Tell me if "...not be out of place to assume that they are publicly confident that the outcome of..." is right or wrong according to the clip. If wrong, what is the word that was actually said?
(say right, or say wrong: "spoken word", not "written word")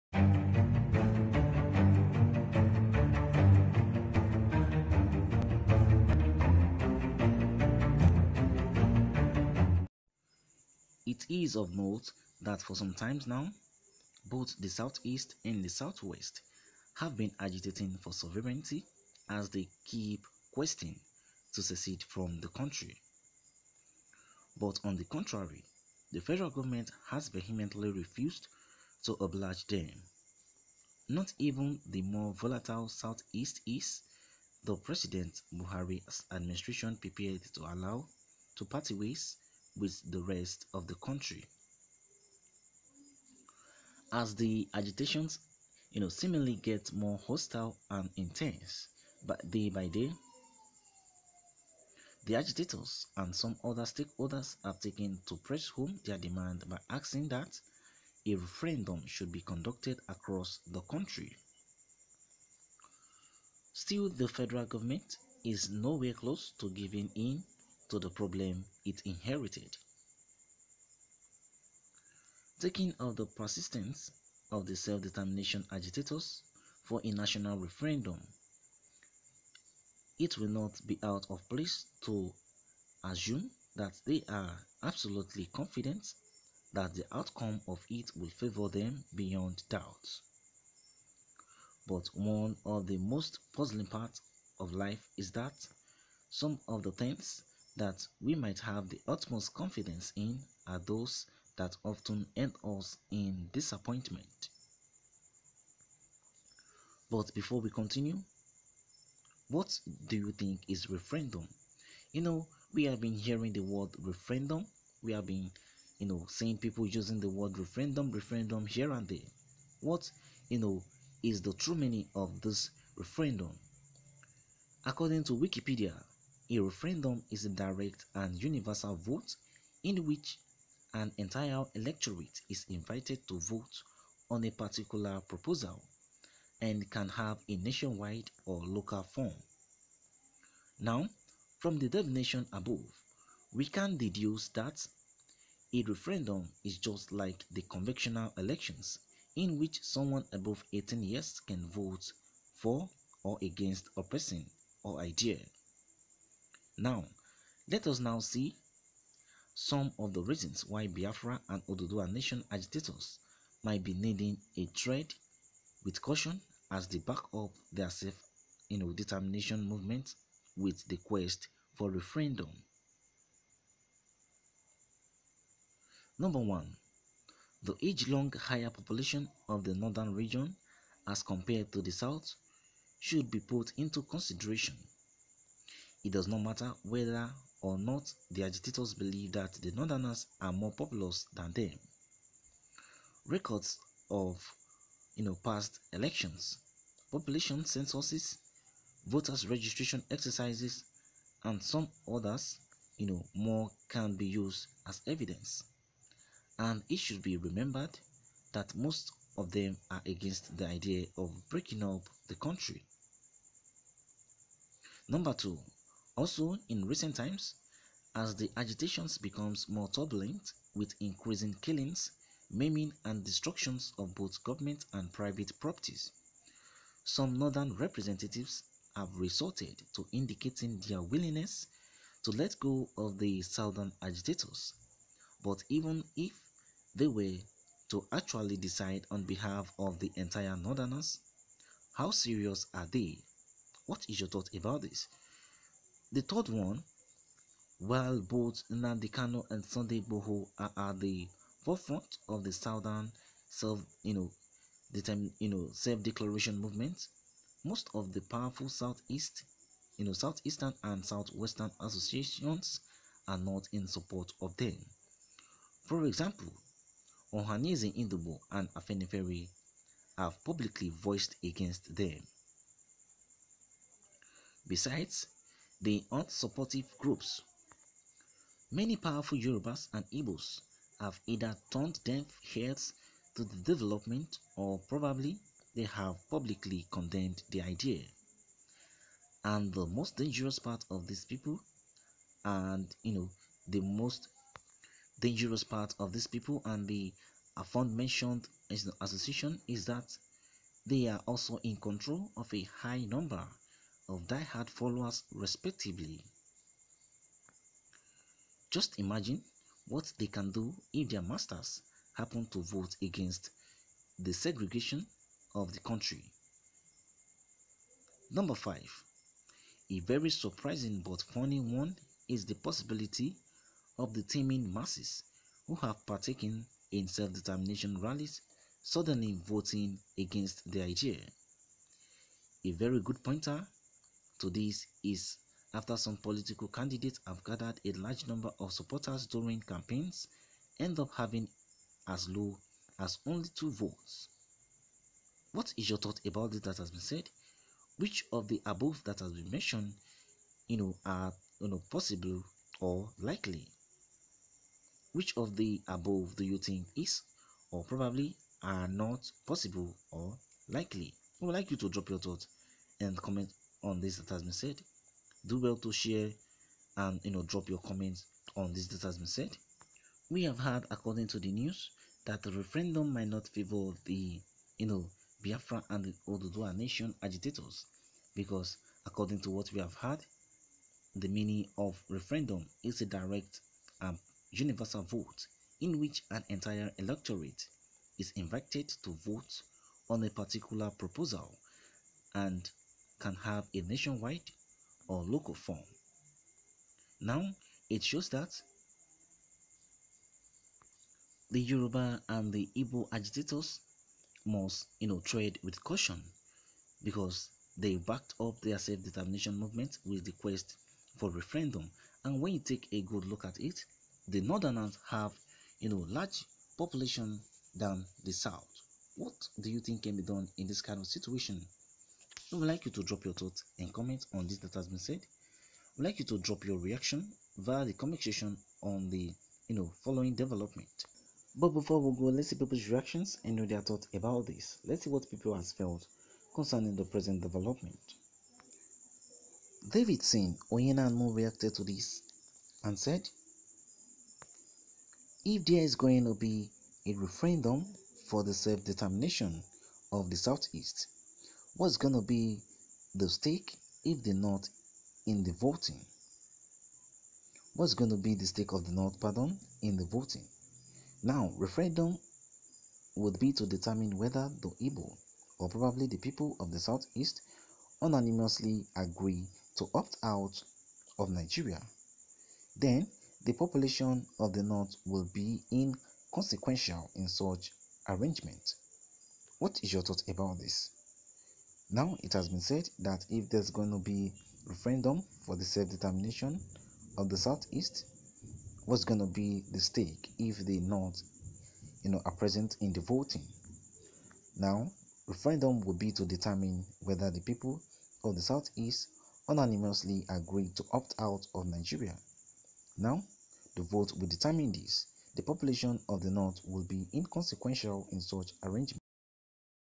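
wrong: "absolutely", not "publicly".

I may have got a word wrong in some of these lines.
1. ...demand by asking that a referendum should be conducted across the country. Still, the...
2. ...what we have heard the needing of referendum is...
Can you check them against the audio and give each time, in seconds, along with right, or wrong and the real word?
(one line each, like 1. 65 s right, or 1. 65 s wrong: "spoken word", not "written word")
1. 56 s right
2. 379 s wrong: "meaning", not "needing".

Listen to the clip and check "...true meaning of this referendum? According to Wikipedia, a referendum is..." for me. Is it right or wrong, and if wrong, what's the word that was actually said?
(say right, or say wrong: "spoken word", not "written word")
right.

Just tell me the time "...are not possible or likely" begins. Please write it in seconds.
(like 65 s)
358 s.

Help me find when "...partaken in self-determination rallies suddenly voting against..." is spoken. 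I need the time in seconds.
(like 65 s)
326 s.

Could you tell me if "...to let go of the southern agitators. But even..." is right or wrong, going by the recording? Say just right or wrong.
right.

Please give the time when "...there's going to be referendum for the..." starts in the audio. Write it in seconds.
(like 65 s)
483 s.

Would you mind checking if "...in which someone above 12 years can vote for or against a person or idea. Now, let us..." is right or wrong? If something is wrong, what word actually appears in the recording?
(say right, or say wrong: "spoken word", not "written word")
wrong: "18", not "12".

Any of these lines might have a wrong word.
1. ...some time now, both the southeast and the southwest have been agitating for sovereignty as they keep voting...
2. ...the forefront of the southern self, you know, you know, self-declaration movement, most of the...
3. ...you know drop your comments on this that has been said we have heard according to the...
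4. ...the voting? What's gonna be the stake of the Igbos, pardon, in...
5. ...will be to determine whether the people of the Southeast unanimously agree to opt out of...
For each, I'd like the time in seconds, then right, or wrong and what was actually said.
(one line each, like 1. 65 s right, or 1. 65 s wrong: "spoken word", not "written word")
1. 12 s wrong: "questing", not "voting"
2. 250 s right
3. 367 s right
4. 455 s wrong: "North", not "Igbos"
5. 495 s right.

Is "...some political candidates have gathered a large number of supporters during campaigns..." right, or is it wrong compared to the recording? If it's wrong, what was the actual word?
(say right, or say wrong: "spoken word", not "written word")
right.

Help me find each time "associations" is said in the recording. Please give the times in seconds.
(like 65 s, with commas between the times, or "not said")
261 s, 298 s.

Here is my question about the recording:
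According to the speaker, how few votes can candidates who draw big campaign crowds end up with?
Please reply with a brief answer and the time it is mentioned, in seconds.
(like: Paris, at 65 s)
2, at 343 s.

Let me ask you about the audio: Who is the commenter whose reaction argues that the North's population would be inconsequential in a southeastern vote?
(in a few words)
David Sin Oyenanmo.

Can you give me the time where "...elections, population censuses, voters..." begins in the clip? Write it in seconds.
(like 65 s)
195 s.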